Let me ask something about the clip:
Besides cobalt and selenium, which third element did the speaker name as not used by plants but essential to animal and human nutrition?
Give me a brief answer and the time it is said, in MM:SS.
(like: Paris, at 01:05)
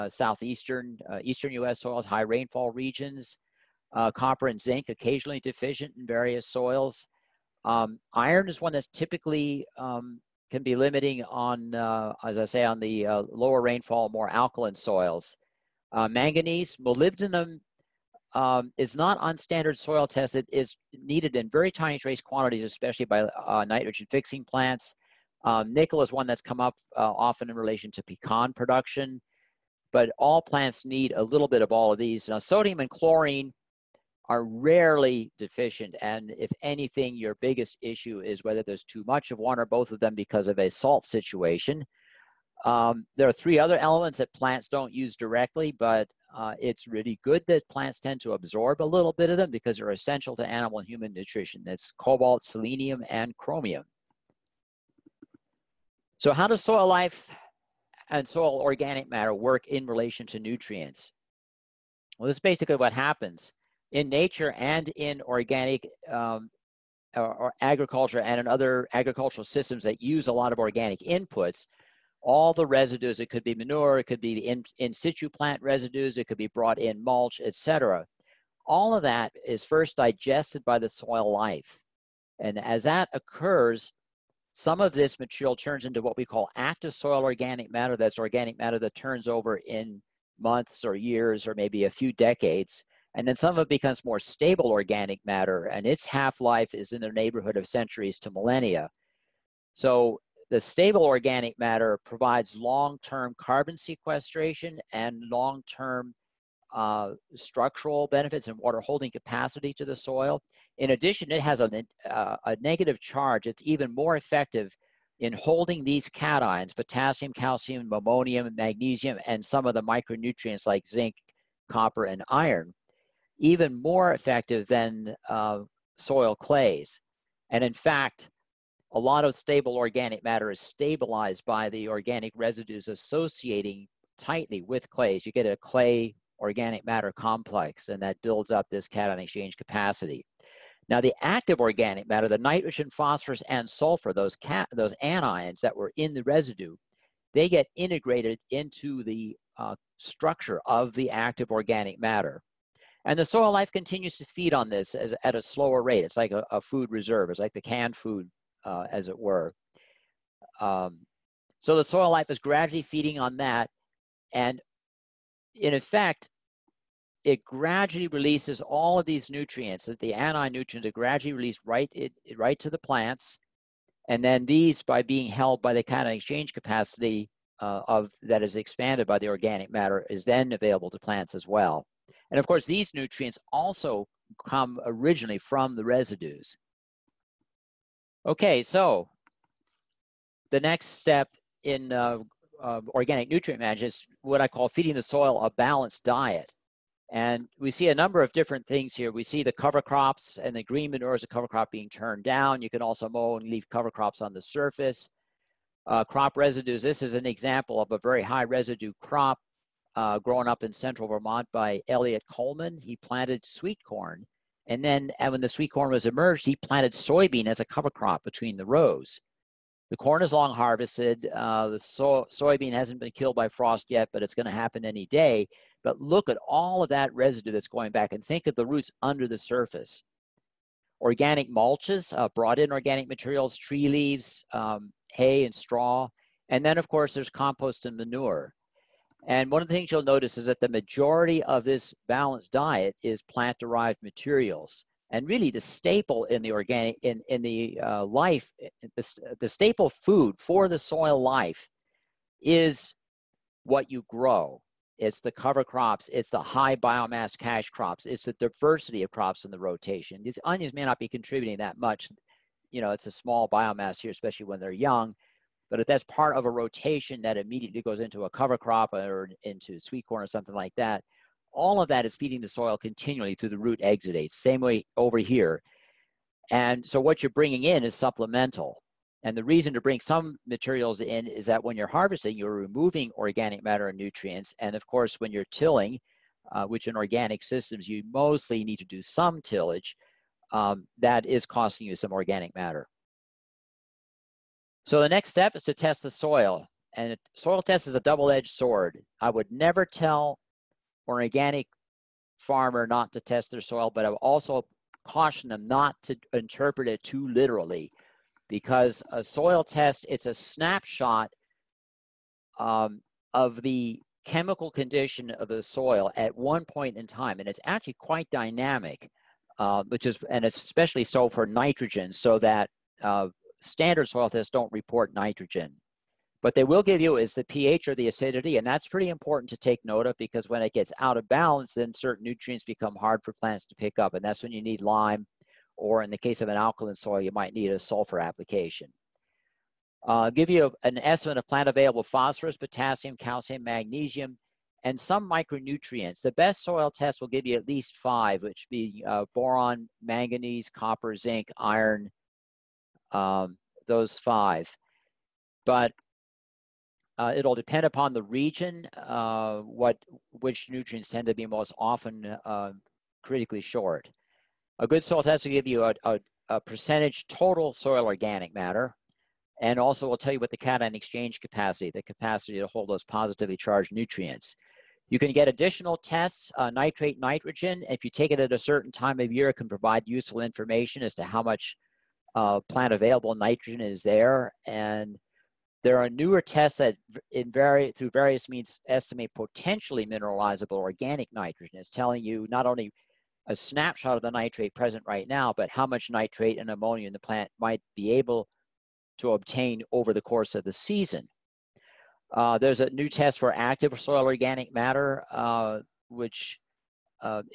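Chromium, at 00:53.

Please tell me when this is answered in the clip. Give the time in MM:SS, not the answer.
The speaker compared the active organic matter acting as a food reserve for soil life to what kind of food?
02:37.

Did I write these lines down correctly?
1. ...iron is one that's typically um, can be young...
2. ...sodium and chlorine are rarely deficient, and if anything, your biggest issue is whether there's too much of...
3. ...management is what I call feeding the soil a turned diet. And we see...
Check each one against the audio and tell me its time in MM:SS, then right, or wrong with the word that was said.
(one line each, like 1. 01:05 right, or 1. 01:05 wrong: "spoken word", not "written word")
1. 00:08 wrong: "limiting", not "young"
2. 00:32 right
3. 03:13 wrong: "balanced", not "turned".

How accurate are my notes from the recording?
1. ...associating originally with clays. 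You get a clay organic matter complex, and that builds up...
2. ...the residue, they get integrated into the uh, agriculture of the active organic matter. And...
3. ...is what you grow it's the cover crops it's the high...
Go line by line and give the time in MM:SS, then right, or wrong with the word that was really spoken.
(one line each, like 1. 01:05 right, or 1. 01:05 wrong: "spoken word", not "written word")
1. 02:12 wrong: "tightly", not "originally"
2. 02:26 wrong: "structure", not "agriculture"
3. 04:12 right.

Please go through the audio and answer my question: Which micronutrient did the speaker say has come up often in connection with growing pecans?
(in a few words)
Nickel.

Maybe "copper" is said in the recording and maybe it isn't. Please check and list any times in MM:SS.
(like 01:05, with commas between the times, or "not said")
00:04, 02:01, 05:50.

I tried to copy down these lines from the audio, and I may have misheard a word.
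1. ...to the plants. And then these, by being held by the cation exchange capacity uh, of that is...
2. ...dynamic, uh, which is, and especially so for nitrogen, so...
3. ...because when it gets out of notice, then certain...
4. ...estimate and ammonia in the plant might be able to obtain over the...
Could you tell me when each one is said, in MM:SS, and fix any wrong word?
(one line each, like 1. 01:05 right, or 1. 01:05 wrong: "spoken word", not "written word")
1. 02:52 right
2. 05:18 right
3. 05:30 wrong: "balance", not "notice"
4. 06:36 wrong: "nitrate", not "estimate".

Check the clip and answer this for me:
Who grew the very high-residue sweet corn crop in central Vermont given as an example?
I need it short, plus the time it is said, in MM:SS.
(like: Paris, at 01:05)
Eliot Coleman, at 03:31.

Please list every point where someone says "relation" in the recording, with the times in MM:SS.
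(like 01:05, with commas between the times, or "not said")
00:27, 00:59.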